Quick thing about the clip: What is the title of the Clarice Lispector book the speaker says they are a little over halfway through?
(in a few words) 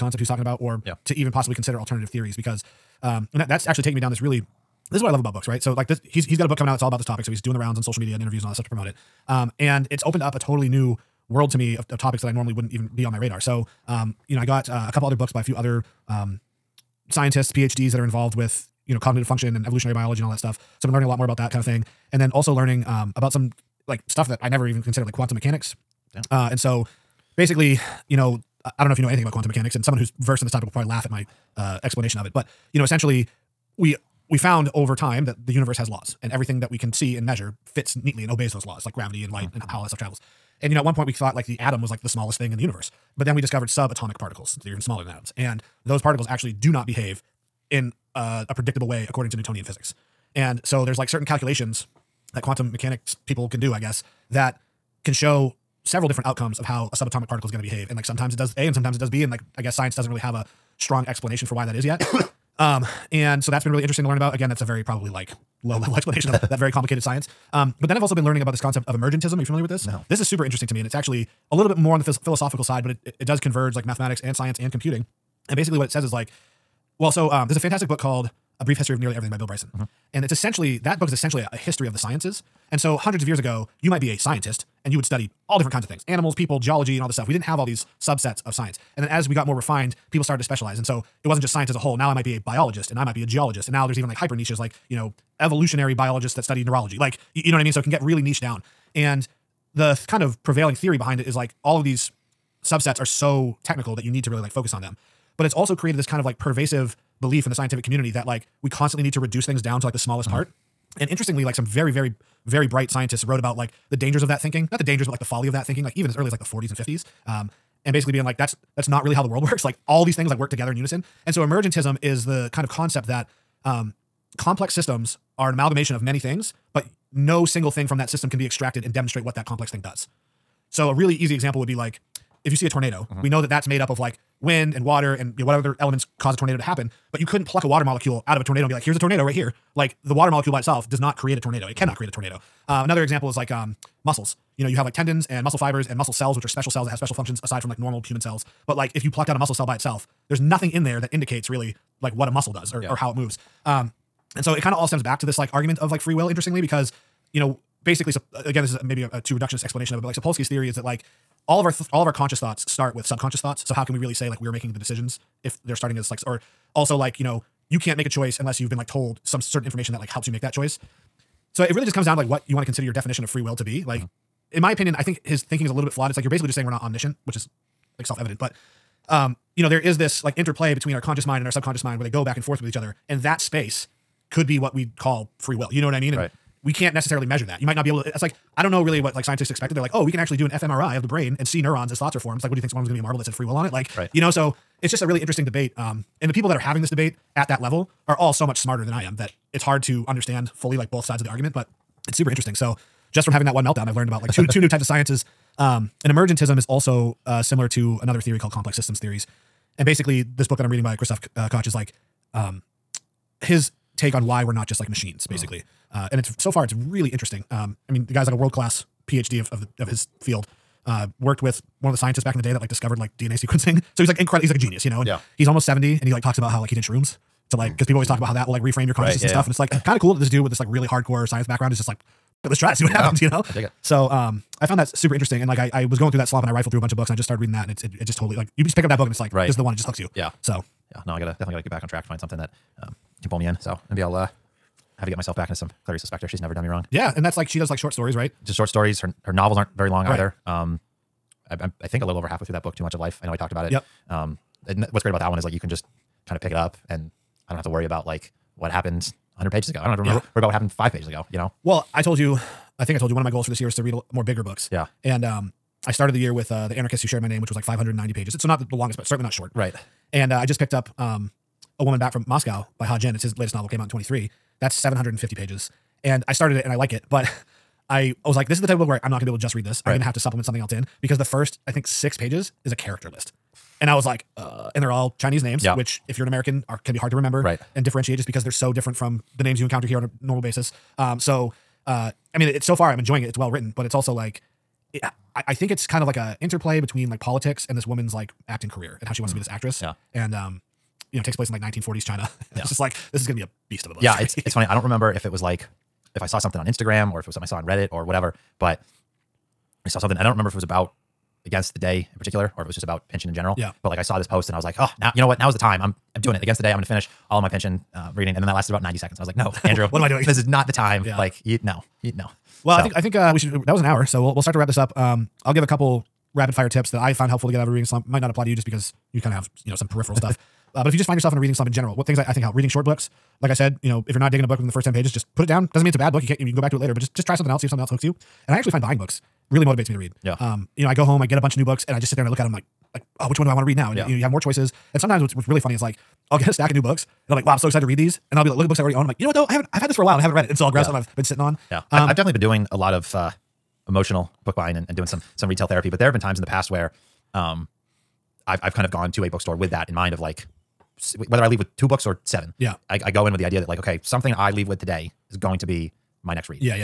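Too Much of Life.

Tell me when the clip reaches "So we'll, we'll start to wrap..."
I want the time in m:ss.
5:24.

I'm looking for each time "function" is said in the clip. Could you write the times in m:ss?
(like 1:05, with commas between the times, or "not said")
0:19, 2:27.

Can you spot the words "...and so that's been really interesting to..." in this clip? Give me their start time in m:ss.
1:03.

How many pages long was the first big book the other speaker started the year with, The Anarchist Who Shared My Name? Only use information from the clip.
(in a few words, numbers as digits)
590.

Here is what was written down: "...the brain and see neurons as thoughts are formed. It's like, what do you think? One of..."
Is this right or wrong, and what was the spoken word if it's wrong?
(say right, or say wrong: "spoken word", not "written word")
right.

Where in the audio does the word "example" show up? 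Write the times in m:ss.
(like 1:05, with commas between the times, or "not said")
2:11, 2:23.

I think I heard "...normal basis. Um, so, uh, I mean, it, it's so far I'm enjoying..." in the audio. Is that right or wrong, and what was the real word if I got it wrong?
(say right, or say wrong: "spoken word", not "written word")
right.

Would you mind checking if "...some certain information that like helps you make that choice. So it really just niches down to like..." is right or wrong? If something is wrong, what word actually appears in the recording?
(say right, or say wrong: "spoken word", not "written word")
wrong: "comes", not "niches".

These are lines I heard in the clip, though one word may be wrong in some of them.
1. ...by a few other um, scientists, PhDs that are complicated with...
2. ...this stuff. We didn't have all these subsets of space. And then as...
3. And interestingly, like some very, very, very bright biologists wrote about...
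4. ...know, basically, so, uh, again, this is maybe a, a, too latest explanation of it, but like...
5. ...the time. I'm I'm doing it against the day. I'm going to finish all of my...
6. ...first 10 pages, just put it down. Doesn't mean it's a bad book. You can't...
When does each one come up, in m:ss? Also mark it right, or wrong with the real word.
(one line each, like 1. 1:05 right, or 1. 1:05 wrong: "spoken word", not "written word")
1. 0:15 wrong: "involved", not "complicated"
2. 1:27 wrong: "science", not "space"
3. 1:50 wrong: "scientists", not "biologists"
4. 2:37 wrong: "reductionist", not "latest"
5. 5:15 right
6. 5:34 right.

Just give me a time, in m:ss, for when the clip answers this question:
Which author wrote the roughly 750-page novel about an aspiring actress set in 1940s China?
4:32.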